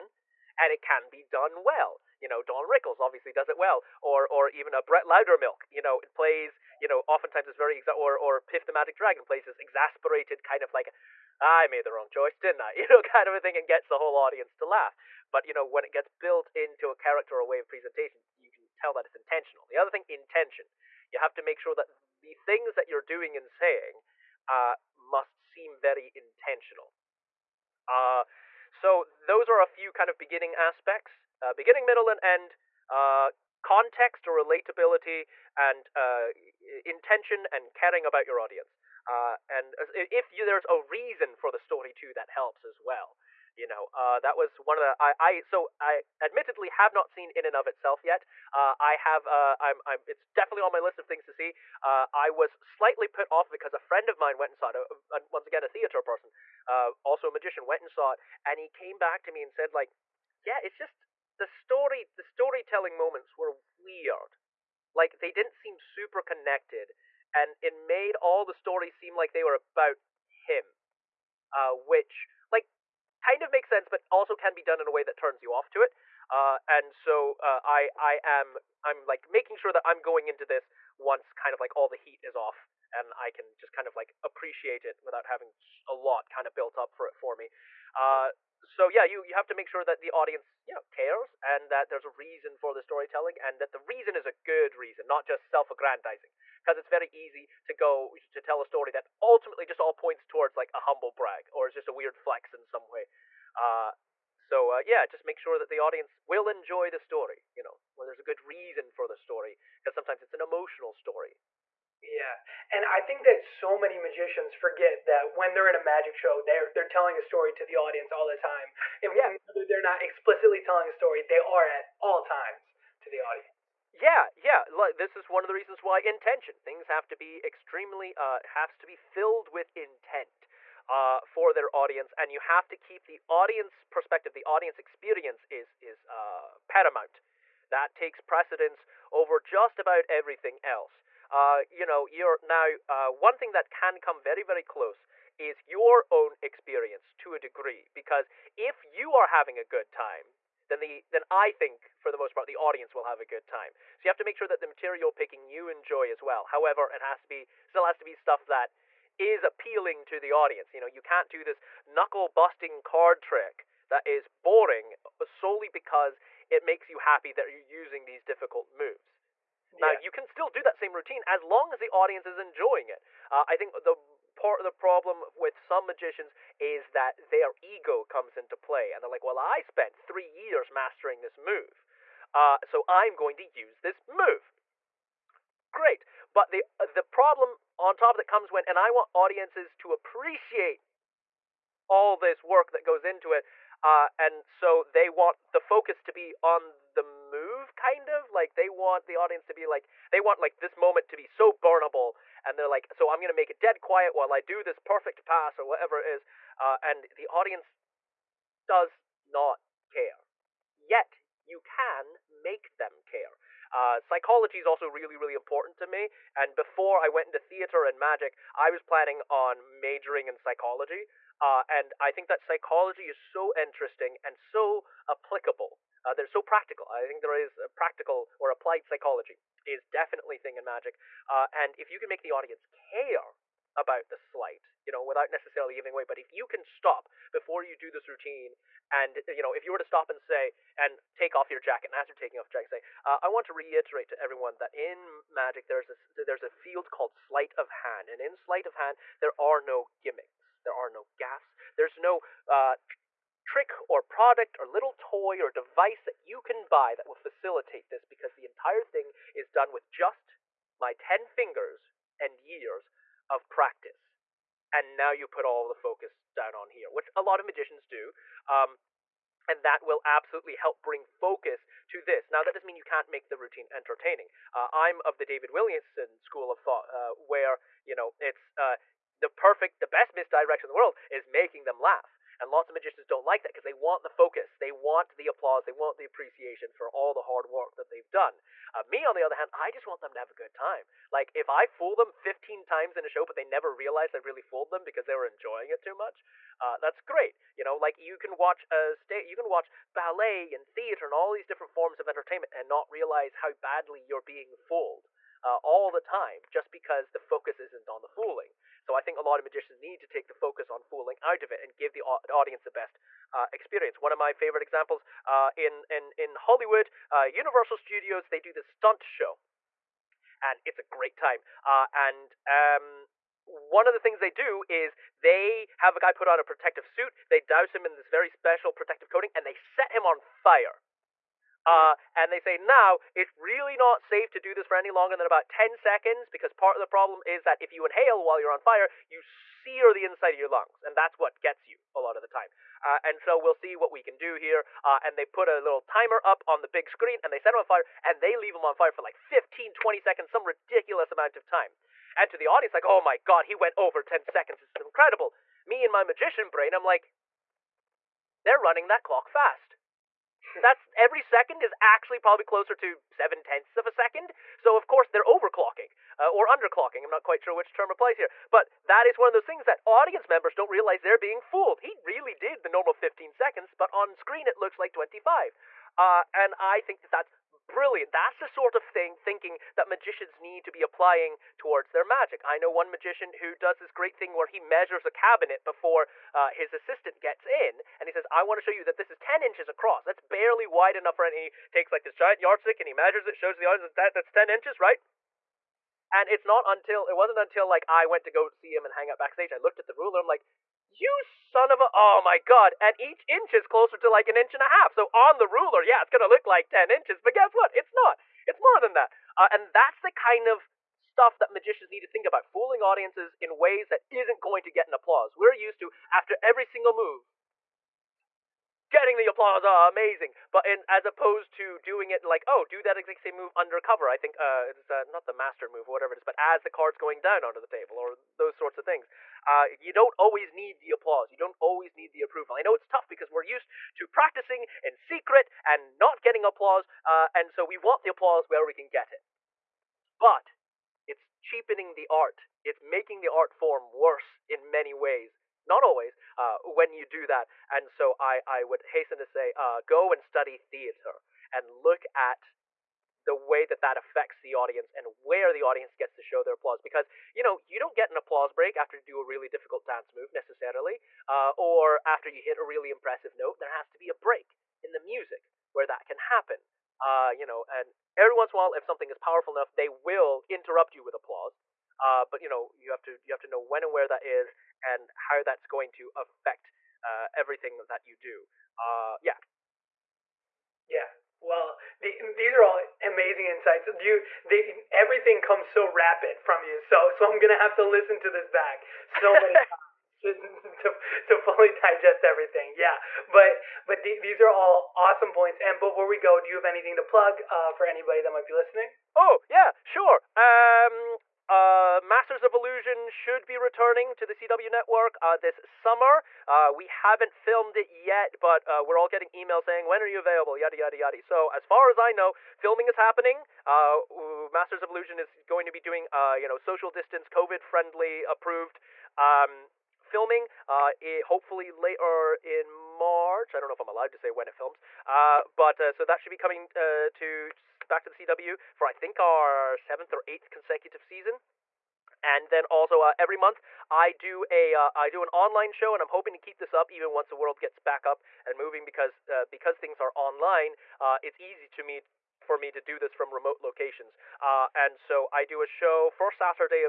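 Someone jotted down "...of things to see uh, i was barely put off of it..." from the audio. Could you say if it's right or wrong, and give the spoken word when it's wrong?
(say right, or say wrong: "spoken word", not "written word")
wrong: "slightly", not "barely".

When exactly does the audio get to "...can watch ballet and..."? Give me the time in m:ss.
4:59.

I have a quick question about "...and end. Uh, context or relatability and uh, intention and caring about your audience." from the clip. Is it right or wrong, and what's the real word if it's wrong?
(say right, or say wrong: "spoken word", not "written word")
right.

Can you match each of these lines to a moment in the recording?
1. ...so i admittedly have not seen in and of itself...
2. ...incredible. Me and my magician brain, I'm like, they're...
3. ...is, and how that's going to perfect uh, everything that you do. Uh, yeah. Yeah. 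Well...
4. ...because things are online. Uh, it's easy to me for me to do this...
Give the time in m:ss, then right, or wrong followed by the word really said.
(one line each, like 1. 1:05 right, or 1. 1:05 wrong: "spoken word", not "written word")
1. 0:45 right
2. 5:54 right
3. 7:54 wrong: "affect", not "perfect"
4. 8:59 right.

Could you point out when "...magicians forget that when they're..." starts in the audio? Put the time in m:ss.
1:53.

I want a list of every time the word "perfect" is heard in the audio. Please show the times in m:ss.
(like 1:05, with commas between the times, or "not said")
3:24, 4:39.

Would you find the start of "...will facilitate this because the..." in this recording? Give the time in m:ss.
4:17.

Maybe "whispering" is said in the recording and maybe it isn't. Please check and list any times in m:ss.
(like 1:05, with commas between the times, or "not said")
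not said.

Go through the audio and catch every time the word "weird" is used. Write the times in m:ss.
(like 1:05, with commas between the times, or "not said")
1:03, 1:41.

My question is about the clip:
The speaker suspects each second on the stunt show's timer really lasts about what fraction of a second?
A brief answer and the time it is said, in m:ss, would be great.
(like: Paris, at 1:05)
7 tenths, at 6:03.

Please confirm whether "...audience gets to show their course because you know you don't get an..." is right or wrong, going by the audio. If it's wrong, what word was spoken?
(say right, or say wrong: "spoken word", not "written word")
wrong: "applause", not "course".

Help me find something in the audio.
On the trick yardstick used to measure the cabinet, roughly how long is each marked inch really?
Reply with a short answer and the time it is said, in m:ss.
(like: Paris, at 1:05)
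An inch and a half, at 6:44.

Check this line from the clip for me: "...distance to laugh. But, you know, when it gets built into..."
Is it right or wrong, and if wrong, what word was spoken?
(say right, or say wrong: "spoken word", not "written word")
wrong: "audience", not "distance".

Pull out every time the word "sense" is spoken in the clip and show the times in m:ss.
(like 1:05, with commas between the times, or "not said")
1:13.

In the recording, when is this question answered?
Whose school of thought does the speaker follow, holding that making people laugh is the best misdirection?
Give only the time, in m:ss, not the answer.
4:35.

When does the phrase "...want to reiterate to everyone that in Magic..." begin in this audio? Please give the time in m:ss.
4:03.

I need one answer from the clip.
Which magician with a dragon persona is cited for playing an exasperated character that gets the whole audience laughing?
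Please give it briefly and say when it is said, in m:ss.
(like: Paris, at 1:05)
Piff the Magic Dragon, at 0:08.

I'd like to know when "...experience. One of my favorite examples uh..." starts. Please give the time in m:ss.
5:13.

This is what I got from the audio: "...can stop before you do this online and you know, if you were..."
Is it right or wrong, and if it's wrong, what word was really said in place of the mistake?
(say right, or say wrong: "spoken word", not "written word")
wrong: "routine", not "online".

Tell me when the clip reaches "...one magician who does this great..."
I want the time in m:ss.
6:22.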